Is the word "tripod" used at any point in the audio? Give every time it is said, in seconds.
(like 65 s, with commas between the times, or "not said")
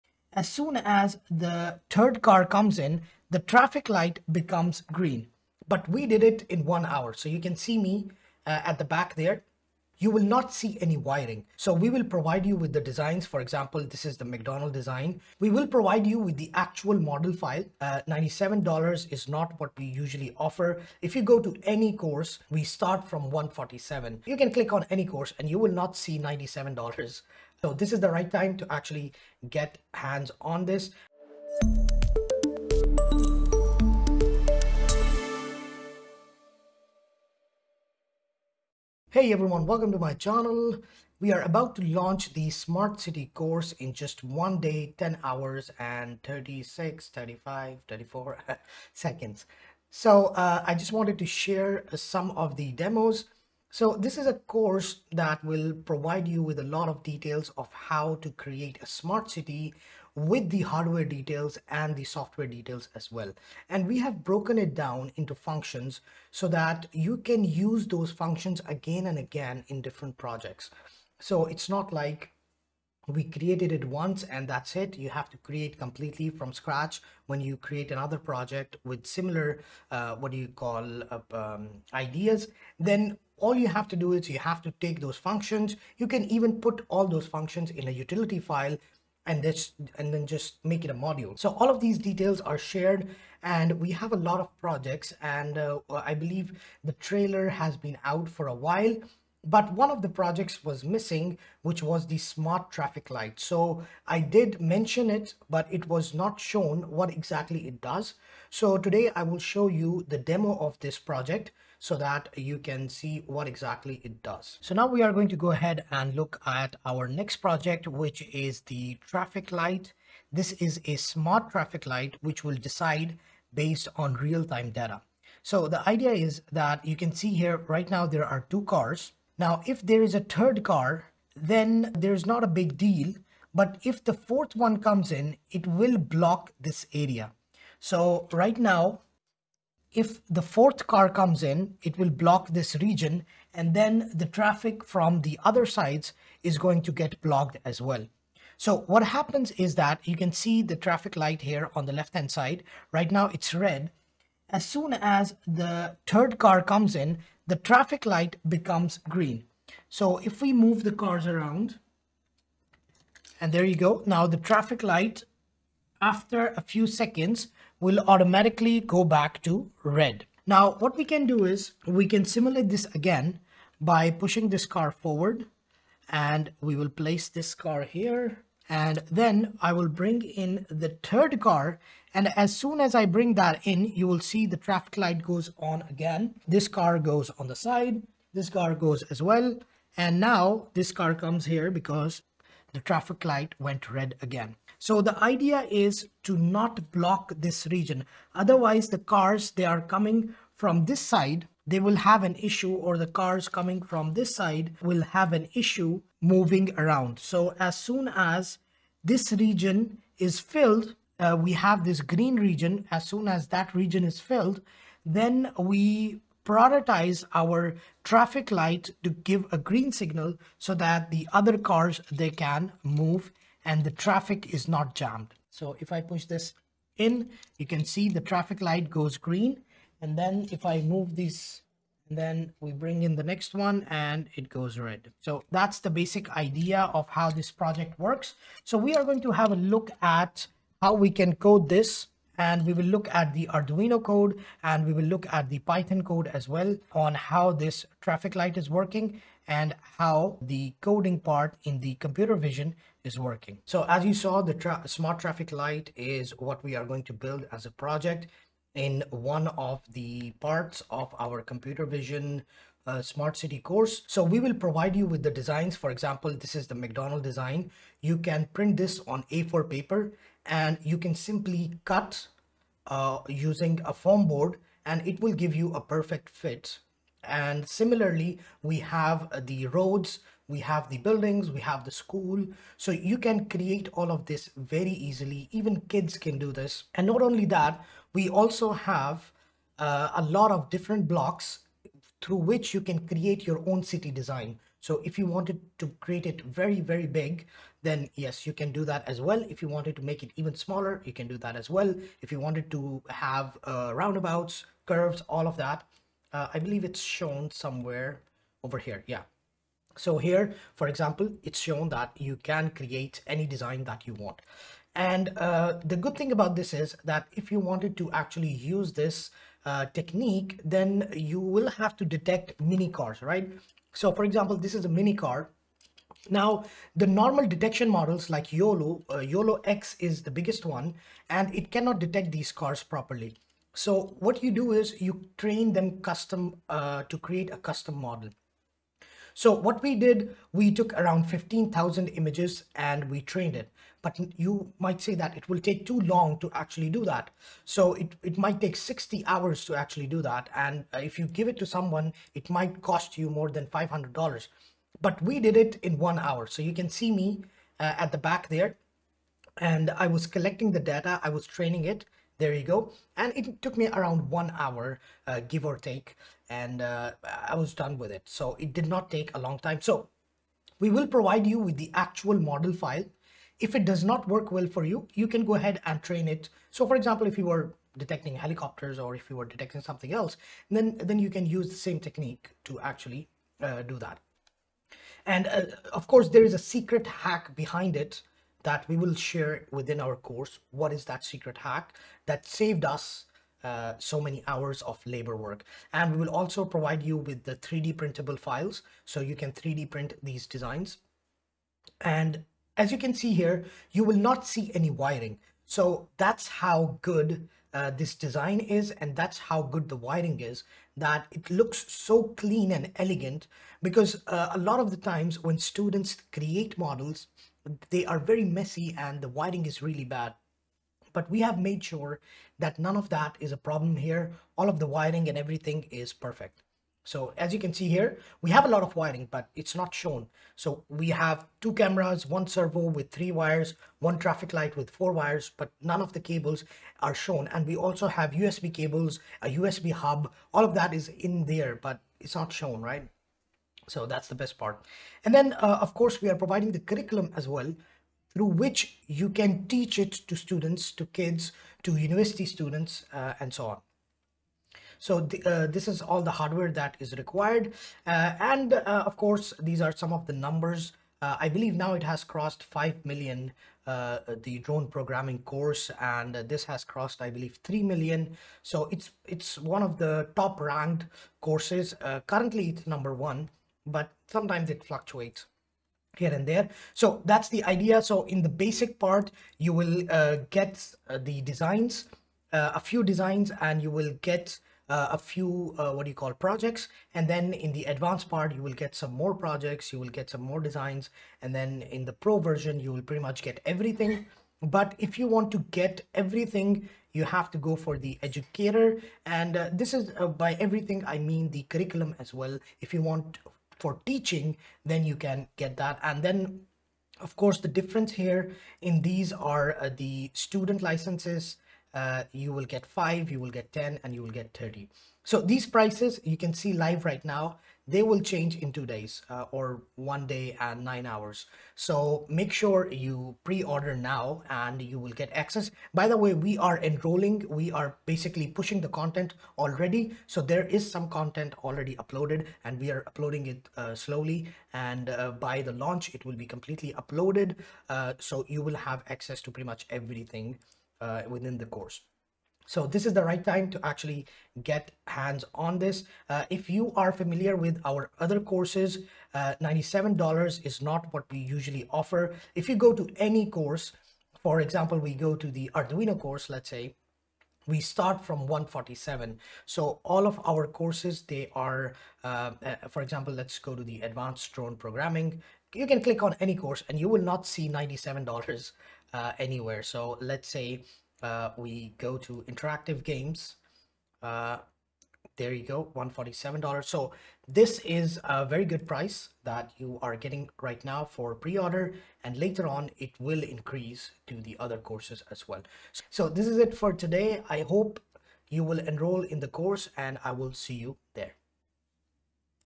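not said.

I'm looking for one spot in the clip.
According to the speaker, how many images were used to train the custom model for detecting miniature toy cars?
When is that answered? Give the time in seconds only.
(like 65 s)
341 s.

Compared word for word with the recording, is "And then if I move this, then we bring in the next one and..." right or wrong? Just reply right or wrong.
right.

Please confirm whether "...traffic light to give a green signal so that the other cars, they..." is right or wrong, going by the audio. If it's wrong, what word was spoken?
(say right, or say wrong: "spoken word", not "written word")
right.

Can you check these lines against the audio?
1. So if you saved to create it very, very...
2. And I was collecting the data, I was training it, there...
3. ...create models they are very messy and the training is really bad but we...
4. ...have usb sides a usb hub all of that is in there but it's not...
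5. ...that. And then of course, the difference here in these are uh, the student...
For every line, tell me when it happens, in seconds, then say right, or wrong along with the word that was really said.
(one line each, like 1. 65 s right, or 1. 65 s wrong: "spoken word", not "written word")
1. 294 s wrong: "wanted", not "saved"
2. 359 s right
3. 416 s wrong: "wiring", not "training"
4. 438 s wrong: "cables", not "sides"
5. 505 s right.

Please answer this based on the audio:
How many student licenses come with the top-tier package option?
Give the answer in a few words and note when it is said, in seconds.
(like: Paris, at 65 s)
30, at 514 s.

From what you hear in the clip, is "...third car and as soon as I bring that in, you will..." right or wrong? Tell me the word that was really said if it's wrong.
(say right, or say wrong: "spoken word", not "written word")
right.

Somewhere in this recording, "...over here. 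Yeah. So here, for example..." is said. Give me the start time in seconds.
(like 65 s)
308 s.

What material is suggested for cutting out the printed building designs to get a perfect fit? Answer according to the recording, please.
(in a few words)
foam board.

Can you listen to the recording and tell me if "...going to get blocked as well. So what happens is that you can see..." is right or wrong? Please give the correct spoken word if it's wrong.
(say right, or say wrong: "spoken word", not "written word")
right.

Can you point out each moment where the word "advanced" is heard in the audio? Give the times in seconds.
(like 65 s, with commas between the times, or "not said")
487 s, 564 s.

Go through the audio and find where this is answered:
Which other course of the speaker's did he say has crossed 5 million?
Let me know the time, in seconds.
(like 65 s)
463 s.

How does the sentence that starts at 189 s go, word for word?
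And now this car comes here because the traffic light went red again.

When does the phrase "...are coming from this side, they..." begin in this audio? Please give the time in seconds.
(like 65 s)
199 s.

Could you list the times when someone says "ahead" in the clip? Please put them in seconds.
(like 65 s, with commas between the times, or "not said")
115 s, 375 s.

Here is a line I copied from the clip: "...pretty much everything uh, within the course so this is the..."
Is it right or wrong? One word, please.
right.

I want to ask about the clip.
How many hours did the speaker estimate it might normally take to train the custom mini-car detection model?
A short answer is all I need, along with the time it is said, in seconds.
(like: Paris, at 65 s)
60 hours, at 348 s.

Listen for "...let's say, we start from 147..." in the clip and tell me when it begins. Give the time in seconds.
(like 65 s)
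556 s.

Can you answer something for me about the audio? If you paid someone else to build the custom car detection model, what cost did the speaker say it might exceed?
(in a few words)
$500.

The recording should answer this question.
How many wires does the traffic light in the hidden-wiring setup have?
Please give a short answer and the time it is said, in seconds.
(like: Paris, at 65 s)
four, at 434 s.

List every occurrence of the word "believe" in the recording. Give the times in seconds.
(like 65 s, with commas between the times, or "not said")
96 s, 306 s, 461 s, 467 s.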